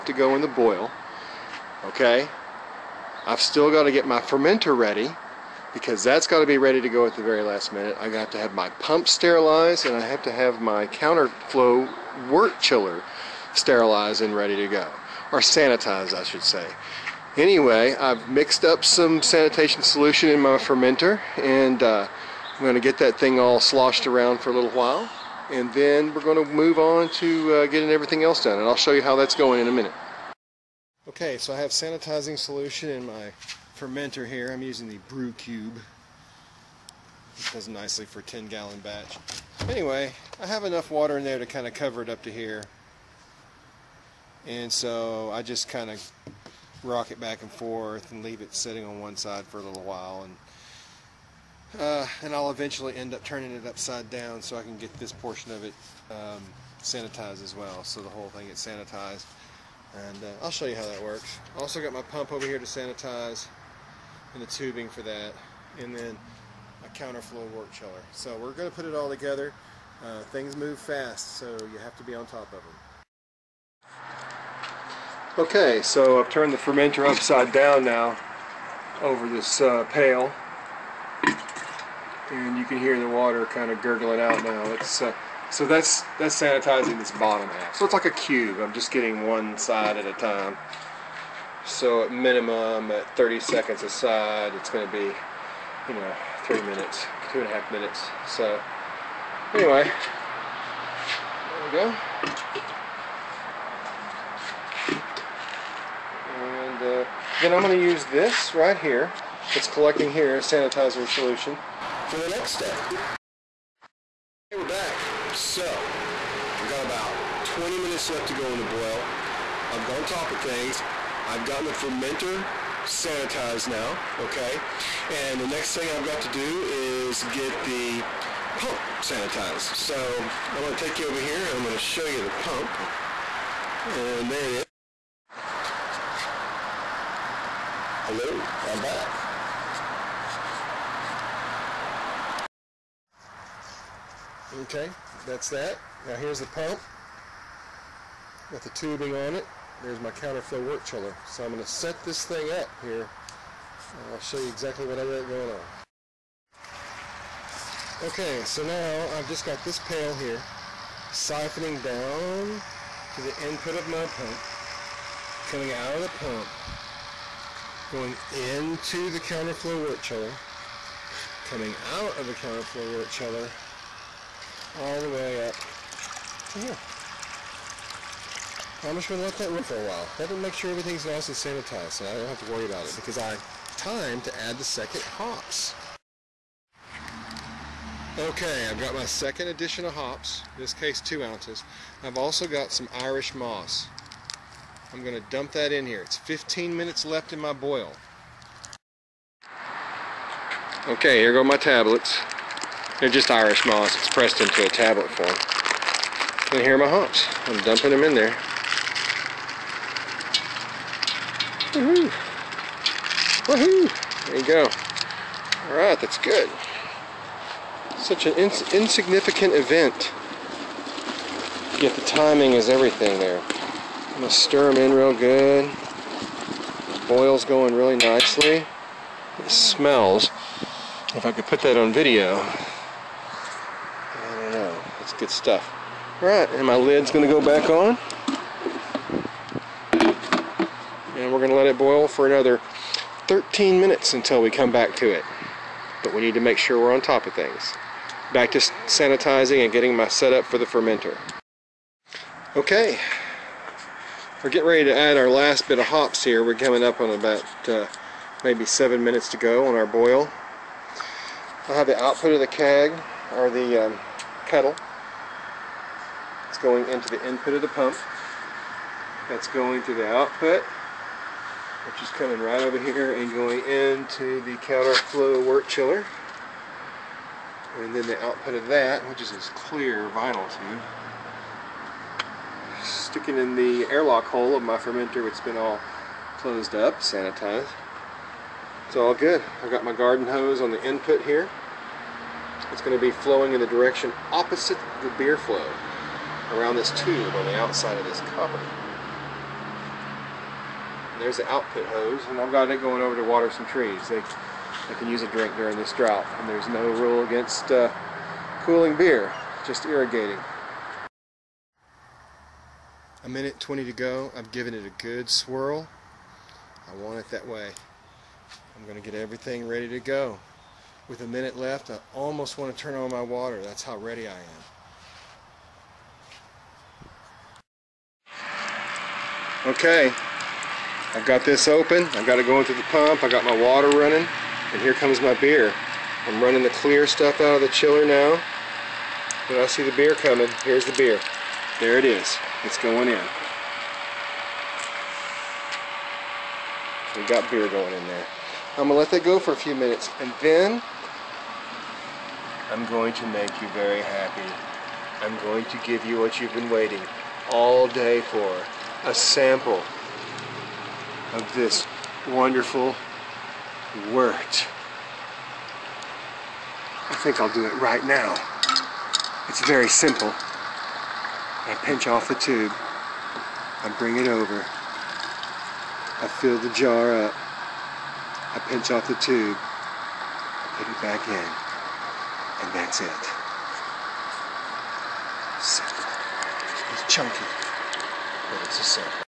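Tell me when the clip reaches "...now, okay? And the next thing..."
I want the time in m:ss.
2:03.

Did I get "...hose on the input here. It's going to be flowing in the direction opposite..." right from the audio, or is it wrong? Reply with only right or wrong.
right.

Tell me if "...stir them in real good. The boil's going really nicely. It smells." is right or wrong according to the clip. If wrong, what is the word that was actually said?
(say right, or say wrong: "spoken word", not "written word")
right.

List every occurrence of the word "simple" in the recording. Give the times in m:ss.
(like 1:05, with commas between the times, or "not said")
6:09, 6:25.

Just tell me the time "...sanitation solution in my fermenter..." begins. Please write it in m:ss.
0:19.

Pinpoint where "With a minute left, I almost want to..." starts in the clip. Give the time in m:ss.
5:21.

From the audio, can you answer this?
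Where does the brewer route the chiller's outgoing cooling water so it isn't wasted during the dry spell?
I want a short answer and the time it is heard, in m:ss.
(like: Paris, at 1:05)
to water some trees, at 5:03.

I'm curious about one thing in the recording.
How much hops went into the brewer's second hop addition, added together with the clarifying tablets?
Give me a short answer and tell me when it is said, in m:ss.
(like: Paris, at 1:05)
2 ounces, at 3:11.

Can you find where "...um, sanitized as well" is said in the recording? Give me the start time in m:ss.
0:56.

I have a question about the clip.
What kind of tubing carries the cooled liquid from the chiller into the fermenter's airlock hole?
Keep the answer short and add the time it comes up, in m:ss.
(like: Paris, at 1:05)
clear vinyl tube, at 4:39.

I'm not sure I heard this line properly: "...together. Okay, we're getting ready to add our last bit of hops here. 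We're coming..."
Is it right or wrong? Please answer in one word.
wrong.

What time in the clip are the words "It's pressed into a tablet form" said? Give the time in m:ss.
3:23.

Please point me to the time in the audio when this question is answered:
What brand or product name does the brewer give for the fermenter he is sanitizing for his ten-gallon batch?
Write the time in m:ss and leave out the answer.
0:35.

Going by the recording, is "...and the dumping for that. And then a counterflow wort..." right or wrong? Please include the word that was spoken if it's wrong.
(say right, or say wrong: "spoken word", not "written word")
wrong: "tubing", not "dumping".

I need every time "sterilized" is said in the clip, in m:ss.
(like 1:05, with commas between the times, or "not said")
0:09, 0:13.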